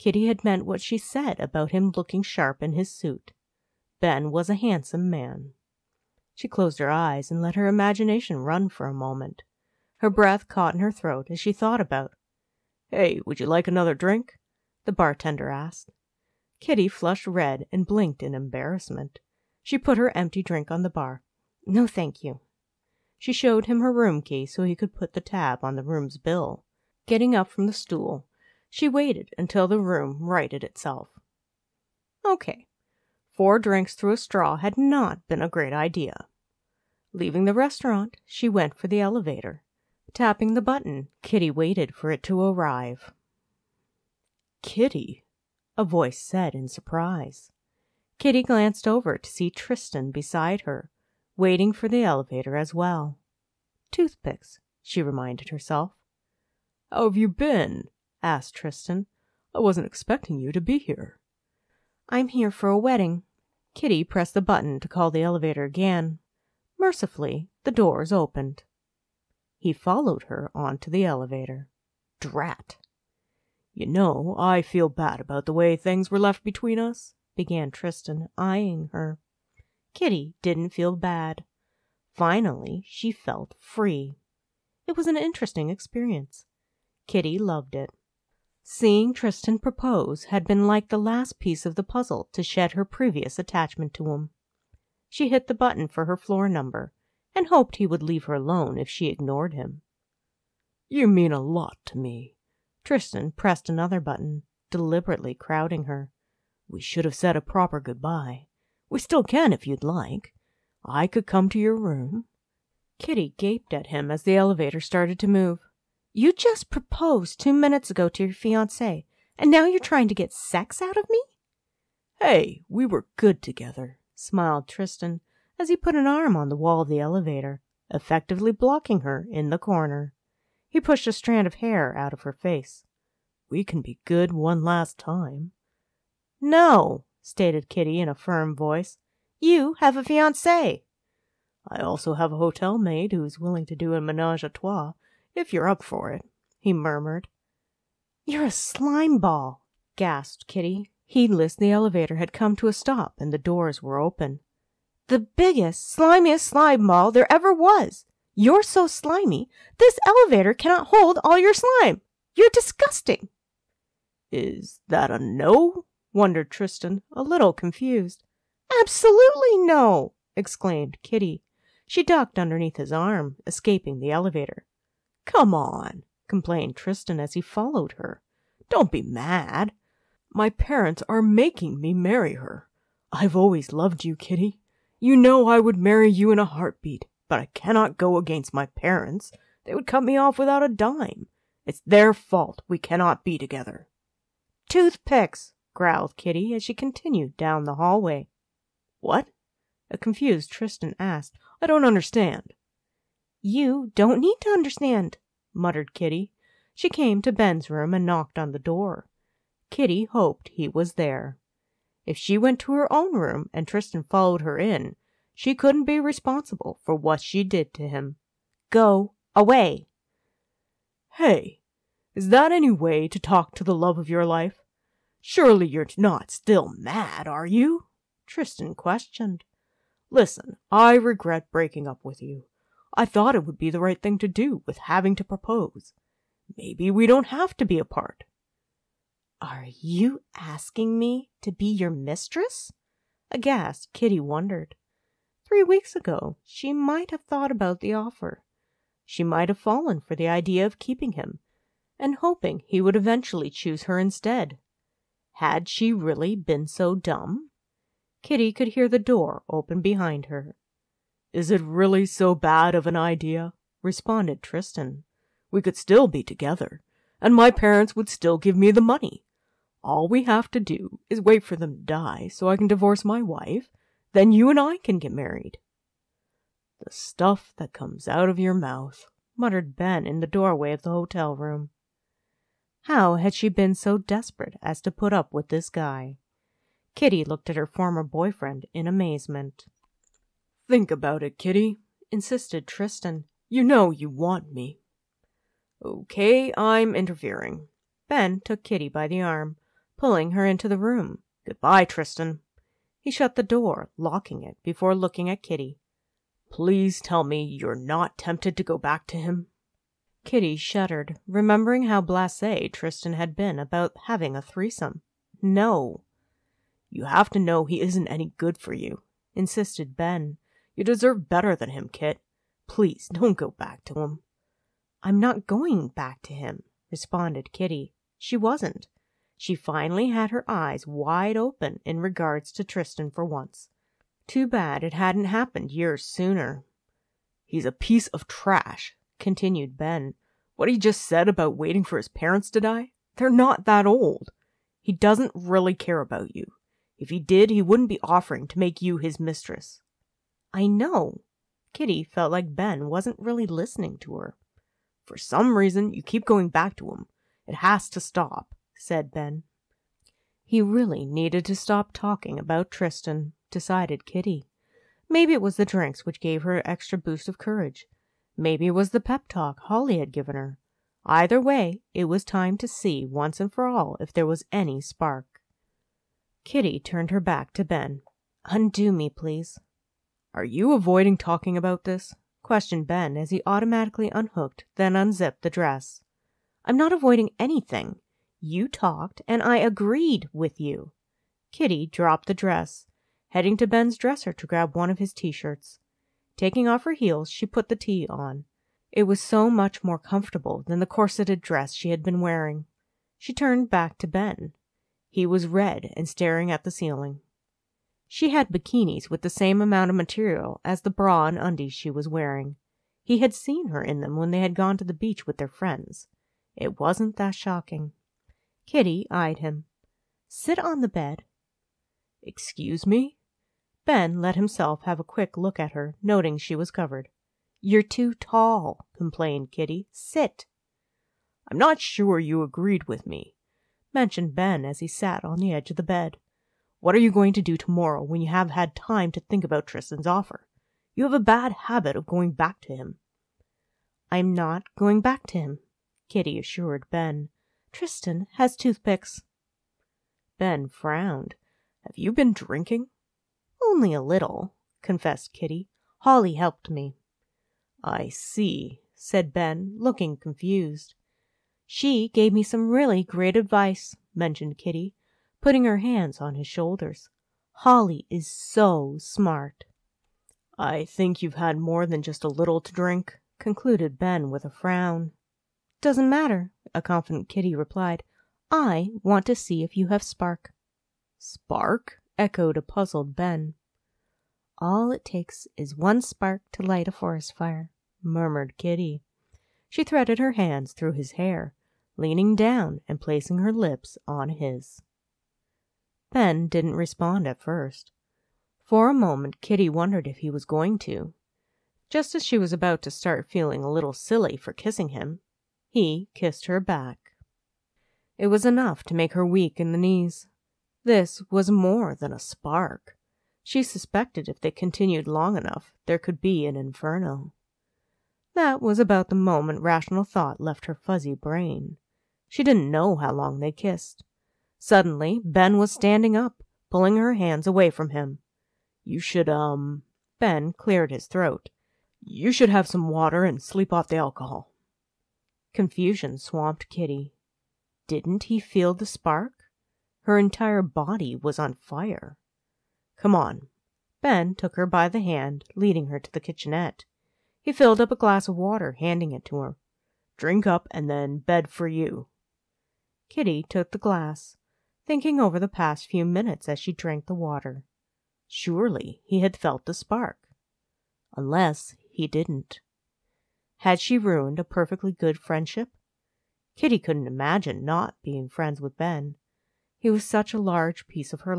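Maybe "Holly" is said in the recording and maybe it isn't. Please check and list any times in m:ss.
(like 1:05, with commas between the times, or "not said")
6:09, 7:35, 7:47.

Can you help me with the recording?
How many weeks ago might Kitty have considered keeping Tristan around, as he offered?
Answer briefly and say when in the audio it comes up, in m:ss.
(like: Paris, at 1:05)
3, at 4:05.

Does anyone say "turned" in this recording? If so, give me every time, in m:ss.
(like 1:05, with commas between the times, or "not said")
6:16, 6:43.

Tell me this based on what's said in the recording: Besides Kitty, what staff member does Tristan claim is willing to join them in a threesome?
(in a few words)
A hotel maid.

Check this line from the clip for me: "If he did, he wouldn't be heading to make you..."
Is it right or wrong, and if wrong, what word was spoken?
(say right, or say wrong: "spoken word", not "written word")
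wrong: "offering", not "heading".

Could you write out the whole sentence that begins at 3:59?
Are you asking me to be your mistress?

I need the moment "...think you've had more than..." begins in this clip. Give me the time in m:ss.
7:50.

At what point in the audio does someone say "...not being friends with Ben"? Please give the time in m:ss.
9:27.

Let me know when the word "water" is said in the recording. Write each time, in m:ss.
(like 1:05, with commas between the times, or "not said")
8:52, 9:08, 9:17.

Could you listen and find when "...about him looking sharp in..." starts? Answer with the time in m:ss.
0:01.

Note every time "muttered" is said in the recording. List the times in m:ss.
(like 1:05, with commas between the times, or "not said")
3:25, 4:39.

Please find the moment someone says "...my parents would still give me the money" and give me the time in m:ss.
4:27.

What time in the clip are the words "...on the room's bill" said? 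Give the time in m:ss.
0:25.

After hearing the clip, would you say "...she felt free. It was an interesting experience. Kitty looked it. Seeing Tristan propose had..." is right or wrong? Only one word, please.
wrong.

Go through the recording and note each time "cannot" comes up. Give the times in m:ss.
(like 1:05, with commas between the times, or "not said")
2:40, 3:07, 3:12.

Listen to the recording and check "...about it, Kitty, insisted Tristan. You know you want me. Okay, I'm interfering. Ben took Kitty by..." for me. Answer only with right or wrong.
right.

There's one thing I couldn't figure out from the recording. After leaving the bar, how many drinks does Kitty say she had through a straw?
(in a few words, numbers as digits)
4.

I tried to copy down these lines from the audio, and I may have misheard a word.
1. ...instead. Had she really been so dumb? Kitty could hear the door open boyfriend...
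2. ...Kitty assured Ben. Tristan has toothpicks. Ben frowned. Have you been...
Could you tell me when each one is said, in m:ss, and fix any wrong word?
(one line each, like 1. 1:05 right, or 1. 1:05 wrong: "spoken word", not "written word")
1. 4:13 wrong: "behind", not "boyfriend"
2. 7:26 right.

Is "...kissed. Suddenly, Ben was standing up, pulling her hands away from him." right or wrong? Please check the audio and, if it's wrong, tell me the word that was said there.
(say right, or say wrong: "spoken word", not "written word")
right.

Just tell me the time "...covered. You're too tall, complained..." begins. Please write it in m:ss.
7:06.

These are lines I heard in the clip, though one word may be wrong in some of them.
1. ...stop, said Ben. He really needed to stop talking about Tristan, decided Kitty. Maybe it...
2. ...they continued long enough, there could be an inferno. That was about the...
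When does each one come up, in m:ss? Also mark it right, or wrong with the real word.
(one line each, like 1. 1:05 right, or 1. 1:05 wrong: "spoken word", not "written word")
1. 5:57 right
2. 8:34 right.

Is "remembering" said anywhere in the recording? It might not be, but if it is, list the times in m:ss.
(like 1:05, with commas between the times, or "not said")
5:11.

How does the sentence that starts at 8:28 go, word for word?
It was enough to make her weak in the knees.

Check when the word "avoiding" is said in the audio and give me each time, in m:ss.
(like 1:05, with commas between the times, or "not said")
6:20, 6:26.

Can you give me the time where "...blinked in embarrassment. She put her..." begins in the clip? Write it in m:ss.
0:17.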